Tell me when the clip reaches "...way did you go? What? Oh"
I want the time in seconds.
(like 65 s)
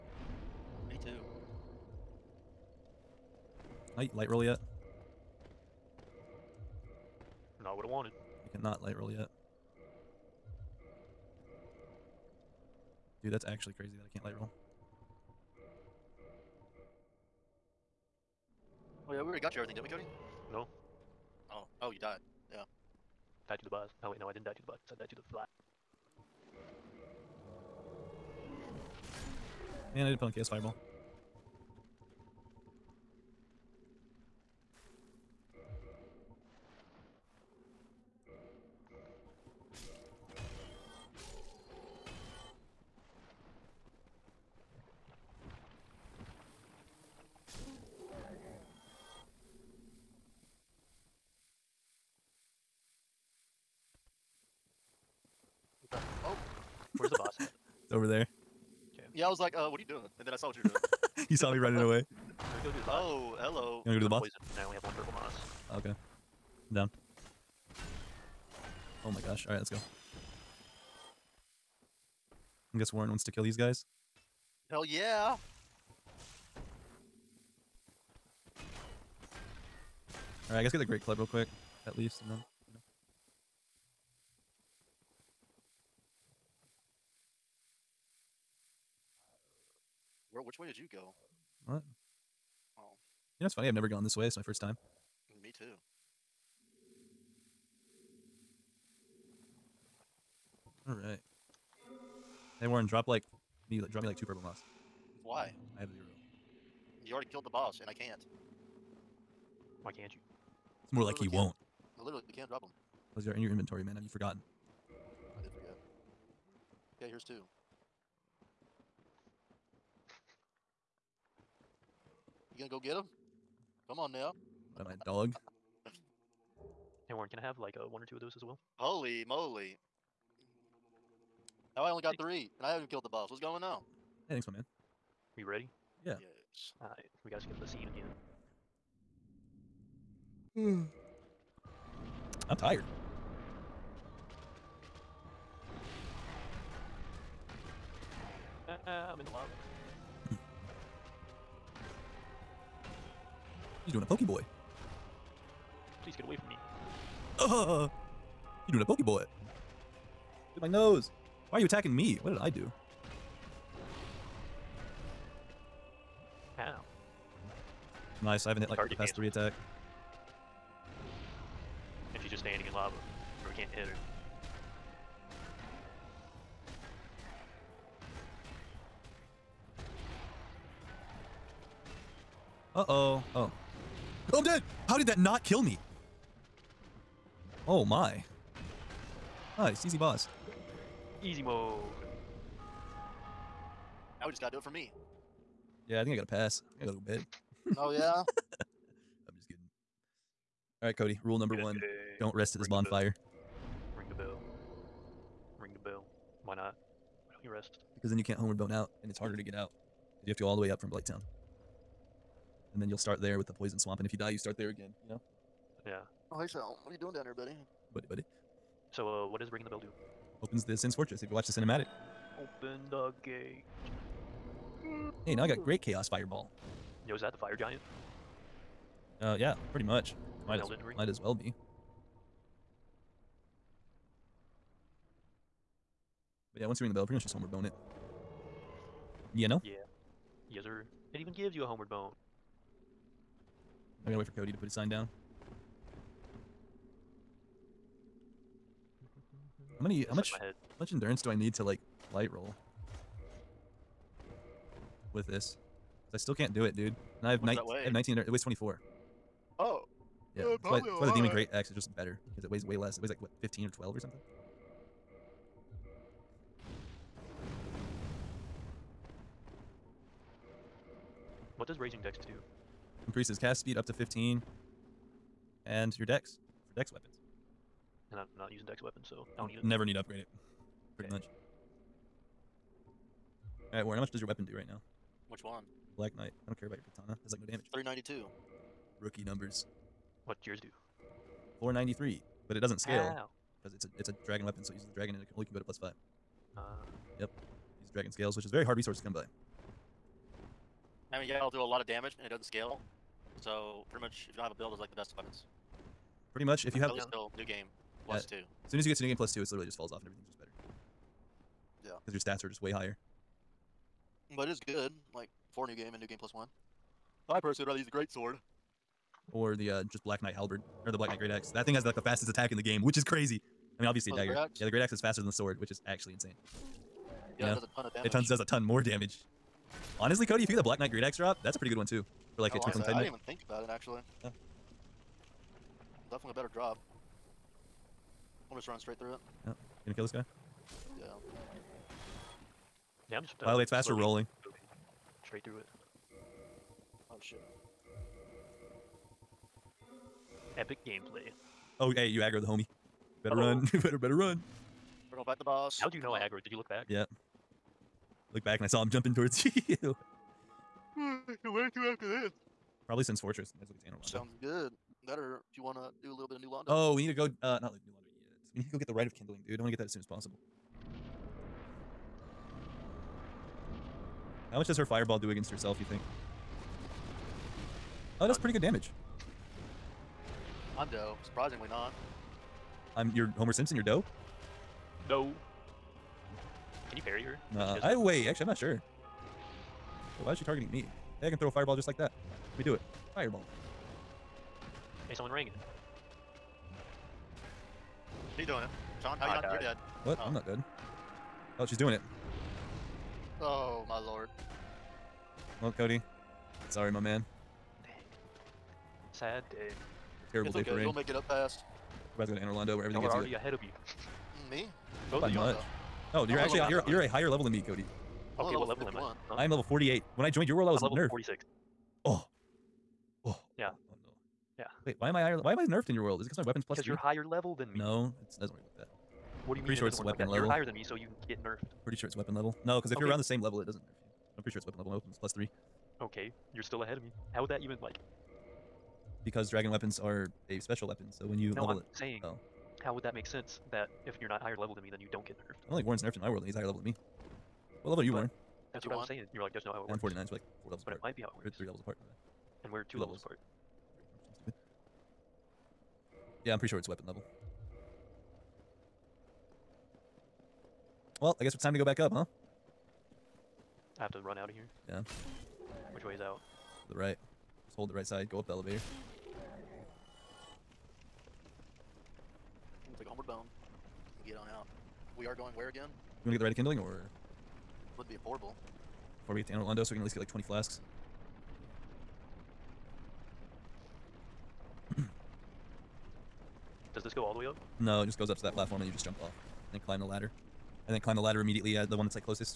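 90 s.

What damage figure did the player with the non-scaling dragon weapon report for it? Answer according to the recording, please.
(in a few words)
493.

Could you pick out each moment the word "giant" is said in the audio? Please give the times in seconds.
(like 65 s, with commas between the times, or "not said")
227 s.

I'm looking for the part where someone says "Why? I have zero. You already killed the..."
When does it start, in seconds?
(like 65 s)
105 s.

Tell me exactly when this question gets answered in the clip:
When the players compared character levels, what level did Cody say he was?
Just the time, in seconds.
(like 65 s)
419 s.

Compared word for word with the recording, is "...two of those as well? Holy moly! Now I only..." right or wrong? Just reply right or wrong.
right.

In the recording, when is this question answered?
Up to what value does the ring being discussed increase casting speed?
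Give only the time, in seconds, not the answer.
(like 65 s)
273 s.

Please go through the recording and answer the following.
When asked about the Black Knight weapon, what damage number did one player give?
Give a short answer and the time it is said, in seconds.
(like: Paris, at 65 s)
392, at 287 s.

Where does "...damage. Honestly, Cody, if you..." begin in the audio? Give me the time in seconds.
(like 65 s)
328 s.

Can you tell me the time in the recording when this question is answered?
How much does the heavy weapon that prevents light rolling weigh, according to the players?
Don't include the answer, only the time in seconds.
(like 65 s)
258 s.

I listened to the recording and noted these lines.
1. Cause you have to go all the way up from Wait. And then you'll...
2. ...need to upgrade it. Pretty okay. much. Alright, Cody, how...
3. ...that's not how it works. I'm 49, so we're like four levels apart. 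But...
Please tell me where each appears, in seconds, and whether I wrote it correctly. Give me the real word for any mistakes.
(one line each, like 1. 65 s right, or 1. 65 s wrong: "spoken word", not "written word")
1. 210 s wrong: "Blighttown", not "Wait"
2. 279 s wrong: "Warren", not "Cody"
3. 449 s right.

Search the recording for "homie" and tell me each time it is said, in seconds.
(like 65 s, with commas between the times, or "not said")
352 s.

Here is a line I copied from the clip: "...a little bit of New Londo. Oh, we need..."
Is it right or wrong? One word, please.
right.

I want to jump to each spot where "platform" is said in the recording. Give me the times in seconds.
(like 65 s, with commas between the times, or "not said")
488 s.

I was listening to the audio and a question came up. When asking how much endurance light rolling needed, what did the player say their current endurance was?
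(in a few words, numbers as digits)
19.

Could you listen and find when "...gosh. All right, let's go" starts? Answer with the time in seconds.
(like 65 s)
69 s.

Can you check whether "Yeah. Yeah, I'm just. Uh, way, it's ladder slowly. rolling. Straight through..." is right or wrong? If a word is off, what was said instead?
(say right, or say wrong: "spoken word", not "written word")
wrong: "faster", not "ladder".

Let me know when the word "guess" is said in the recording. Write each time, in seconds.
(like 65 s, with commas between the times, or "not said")
72 s, 80 s, 461 s.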